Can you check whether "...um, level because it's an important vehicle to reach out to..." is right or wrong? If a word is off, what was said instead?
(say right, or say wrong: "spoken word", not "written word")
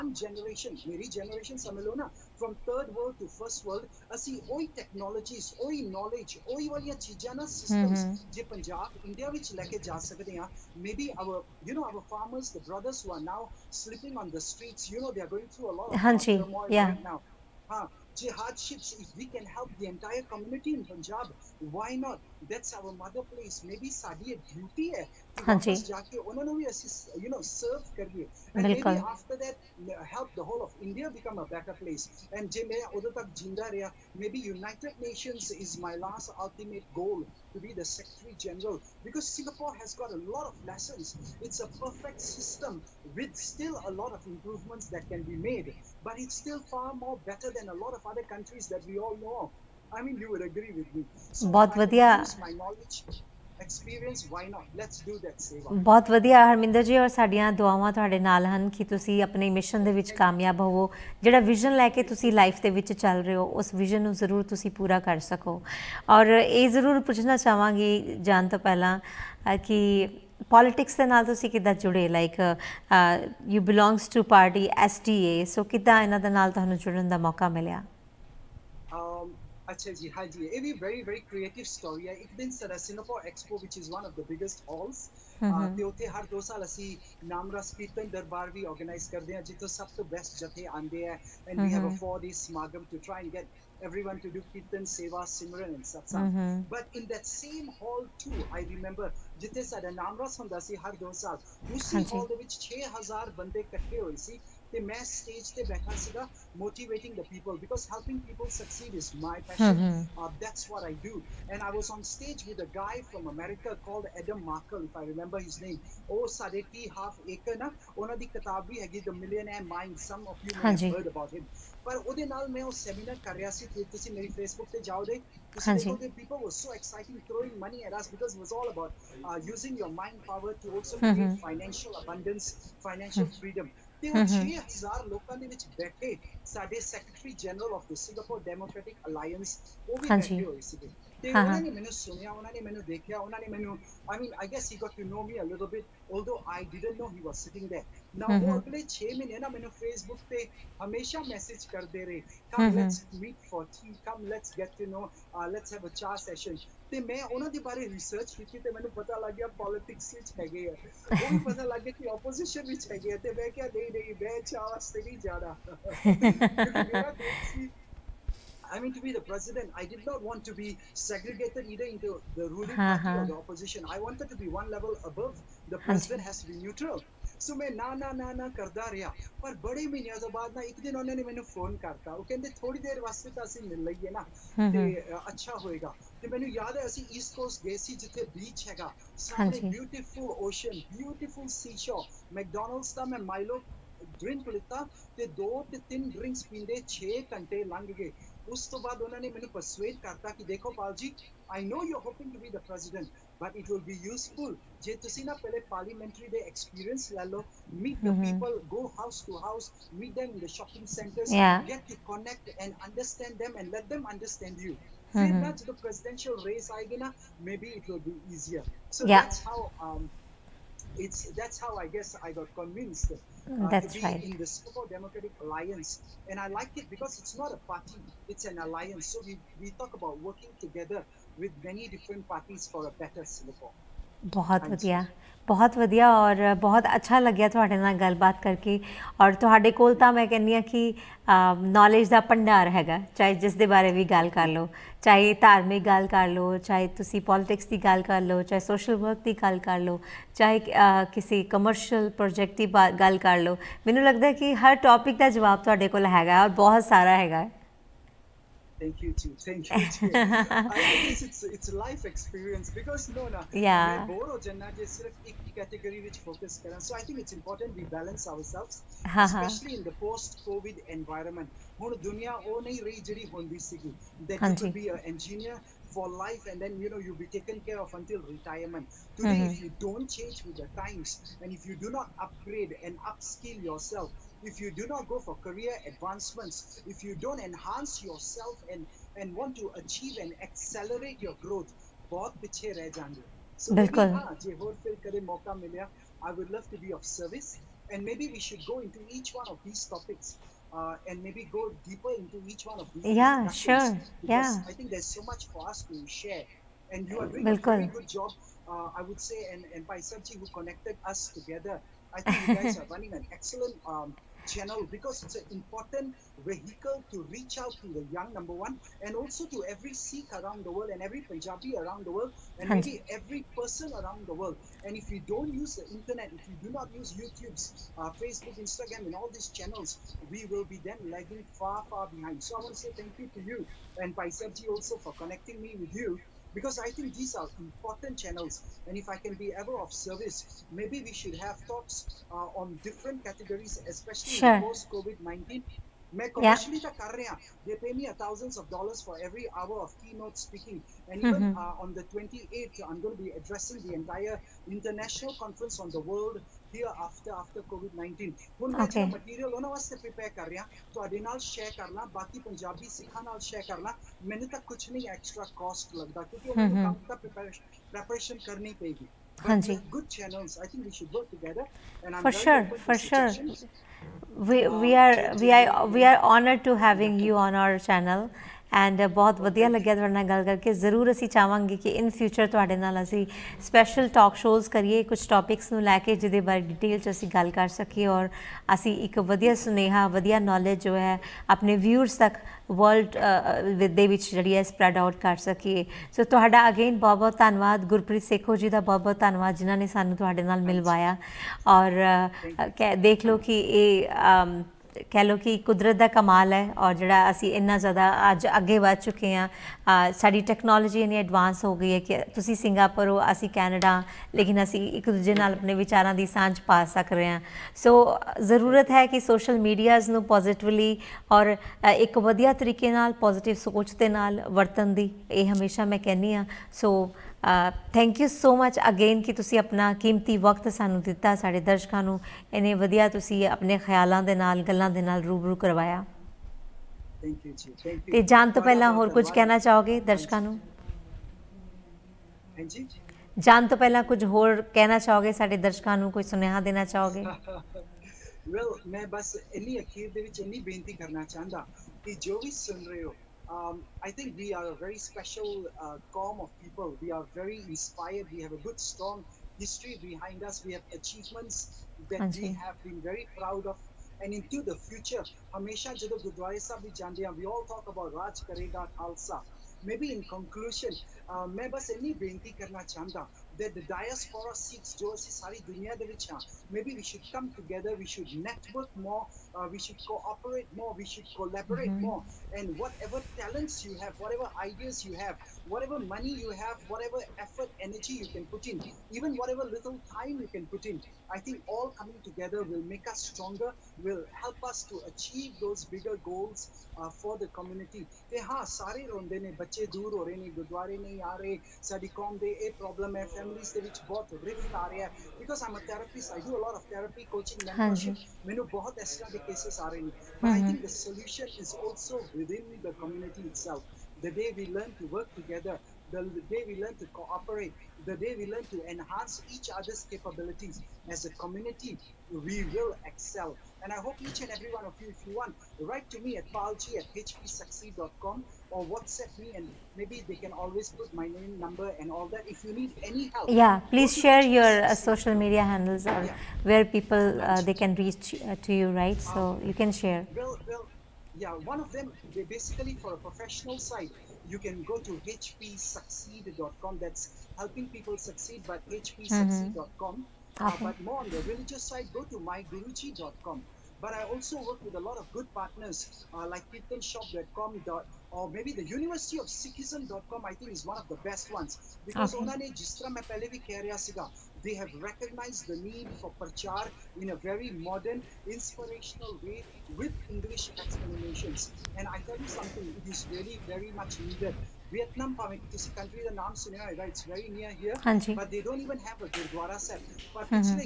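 wrong: "channel", not "level".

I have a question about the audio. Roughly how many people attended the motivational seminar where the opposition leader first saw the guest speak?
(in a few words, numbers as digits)
6000.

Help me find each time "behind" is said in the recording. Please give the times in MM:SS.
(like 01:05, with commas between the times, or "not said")
05:32, 07:40.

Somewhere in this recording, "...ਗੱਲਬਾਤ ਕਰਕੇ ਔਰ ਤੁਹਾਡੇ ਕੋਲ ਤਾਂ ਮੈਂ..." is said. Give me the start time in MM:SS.
03:58.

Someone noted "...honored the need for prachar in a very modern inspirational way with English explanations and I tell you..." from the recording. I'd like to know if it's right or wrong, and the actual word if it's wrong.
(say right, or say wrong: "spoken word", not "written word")
wrong: "recognized", not "honored".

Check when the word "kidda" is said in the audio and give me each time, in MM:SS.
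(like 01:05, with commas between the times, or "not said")
01:11, 01:15.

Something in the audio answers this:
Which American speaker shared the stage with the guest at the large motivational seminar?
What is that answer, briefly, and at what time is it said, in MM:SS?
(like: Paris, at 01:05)
Adam Markel, at 01:54.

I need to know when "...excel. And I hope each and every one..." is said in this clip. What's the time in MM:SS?
08:43.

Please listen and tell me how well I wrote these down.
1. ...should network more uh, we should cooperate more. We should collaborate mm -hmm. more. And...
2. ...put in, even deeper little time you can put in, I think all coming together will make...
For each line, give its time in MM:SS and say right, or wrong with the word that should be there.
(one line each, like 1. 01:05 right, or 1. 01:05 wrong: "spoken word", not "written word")
1. 07:58 right
2. 08:08 wrong: "whatever", not "deeper".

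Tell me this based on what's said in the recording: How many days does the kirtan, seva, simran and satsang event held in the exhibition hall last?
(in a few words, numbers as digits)
4 days.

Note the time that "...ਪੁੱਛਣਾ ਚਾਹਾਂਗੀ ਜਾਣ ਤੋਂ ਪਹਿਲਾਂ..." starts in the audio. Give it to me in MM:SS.
01:07.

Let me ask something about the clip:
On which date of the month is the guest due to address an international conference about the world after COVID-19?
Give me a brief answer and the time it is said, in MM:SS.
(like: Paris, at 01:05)
28th, at 05:52.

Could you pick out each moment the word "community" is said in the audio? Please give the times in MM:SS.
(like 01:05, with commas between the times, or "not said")
00:20, 08:17, 08:33, 08:41.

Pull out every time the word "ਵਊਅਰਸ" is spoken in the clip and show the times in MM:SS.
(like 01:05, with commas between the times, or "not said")
06:31.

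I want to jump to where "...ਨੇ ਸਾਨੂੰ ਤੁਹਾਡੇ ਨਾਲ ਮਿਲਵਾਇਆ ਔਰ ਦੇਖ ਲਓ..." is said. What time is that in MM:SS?
06:39.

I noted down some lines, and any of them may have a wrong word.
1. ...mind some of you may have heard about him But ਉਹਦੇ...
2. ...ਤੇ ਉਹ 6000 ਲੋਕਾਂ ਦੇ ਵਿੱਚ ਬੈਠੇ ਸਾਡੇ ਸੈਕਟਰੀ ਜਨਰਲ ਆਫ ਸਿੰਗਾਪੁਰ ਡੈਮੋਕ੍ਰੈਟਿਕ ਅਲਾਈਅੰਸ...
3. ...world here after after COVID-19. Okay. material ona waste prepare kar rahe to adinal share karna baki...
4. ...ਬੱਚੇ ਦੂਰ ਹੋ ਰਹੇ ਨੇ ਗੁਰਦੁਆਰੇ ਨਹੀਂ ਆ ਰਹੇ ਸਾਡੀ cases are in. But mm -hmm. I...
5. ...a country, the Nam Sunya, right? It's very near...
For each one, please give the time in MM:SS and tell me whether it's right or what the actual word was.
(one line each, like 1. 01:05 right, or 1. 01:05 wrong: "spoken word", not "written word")
1. 01:59 right
2. 02:14 right
3. 05:56 right
4. 08:19 right
5. 09:35 right.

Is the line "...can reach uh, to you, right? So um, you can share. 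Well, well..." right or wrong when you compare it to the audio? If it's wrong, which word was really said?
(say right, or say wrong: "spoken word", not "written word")
right.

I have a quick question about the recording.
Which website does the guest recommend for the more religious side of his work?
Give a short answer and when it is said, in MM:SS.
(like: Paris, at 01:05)
myguruji.com, at 09:12.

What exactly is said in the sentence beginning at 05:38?
And if I can be ever of service, maybe we should have talks uh, on different categories, especially sure.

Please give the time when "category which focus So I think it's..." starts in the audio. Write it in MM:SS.
04:25.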